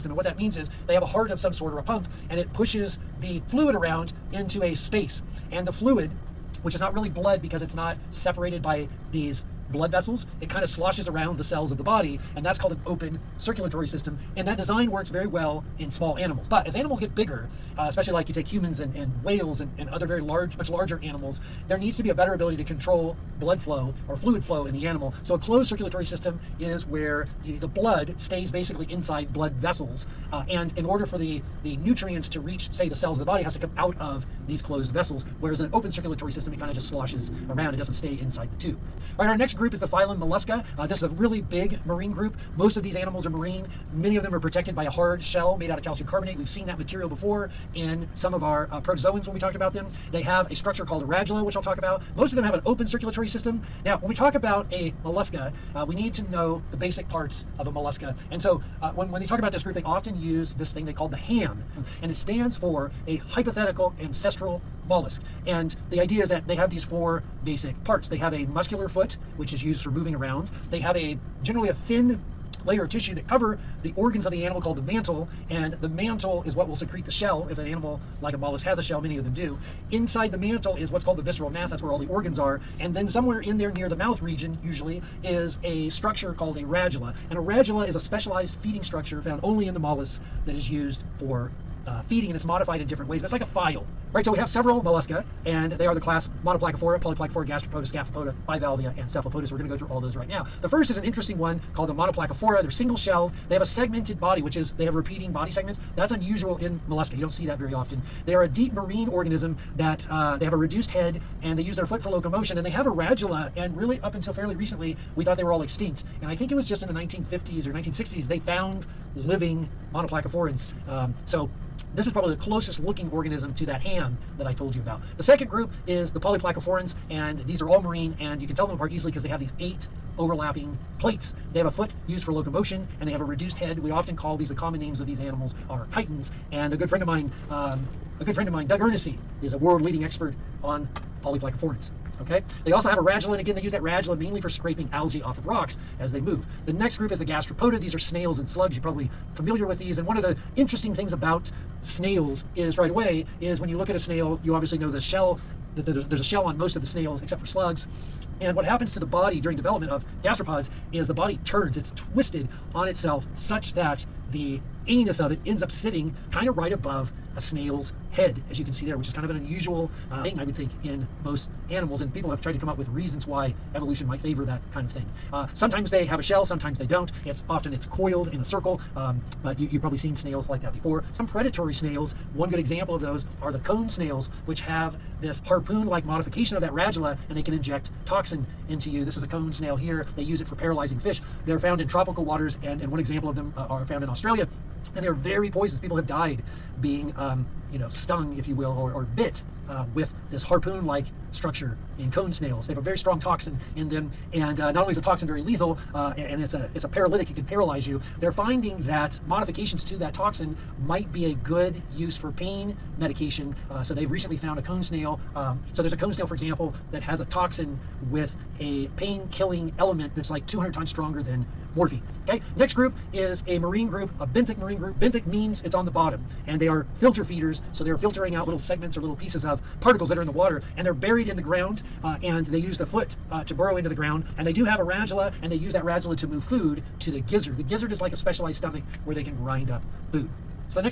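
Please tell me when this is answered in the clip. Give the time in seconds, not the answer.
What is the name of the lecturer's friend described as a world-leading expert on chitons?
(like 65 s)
138 s.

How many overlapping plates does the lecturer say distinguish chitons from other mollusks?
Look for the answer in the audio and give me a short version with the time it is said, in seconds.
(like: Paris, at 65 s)
8, at 129 s.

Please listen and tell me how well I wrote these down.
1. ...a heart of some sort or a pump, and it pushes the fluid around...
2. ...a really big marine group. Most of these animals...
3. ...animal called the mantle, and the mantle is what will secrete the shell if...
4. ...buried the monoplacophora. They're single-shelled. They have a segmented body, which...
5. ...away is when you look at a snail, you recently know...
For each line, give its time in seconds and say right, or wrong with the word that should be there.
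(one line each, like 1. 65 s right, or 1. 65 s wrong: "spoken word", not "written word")
1. 1 s right
2. 41 s right
3. 74 s right
4. 101 s wrong: "called", not "buried"
5. 152 s wrong: "obviously", not "recently".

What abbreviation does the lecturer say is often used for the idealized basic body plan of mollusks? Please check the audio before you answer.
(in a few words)
the ham.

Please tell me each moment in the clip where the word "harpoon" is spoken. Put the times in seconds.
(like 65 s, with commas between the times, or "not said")
185 s, 200 s.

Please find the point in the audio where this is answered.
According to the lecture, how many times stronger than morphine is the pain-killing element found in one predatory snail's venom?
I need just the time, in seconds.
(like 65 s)
220 s.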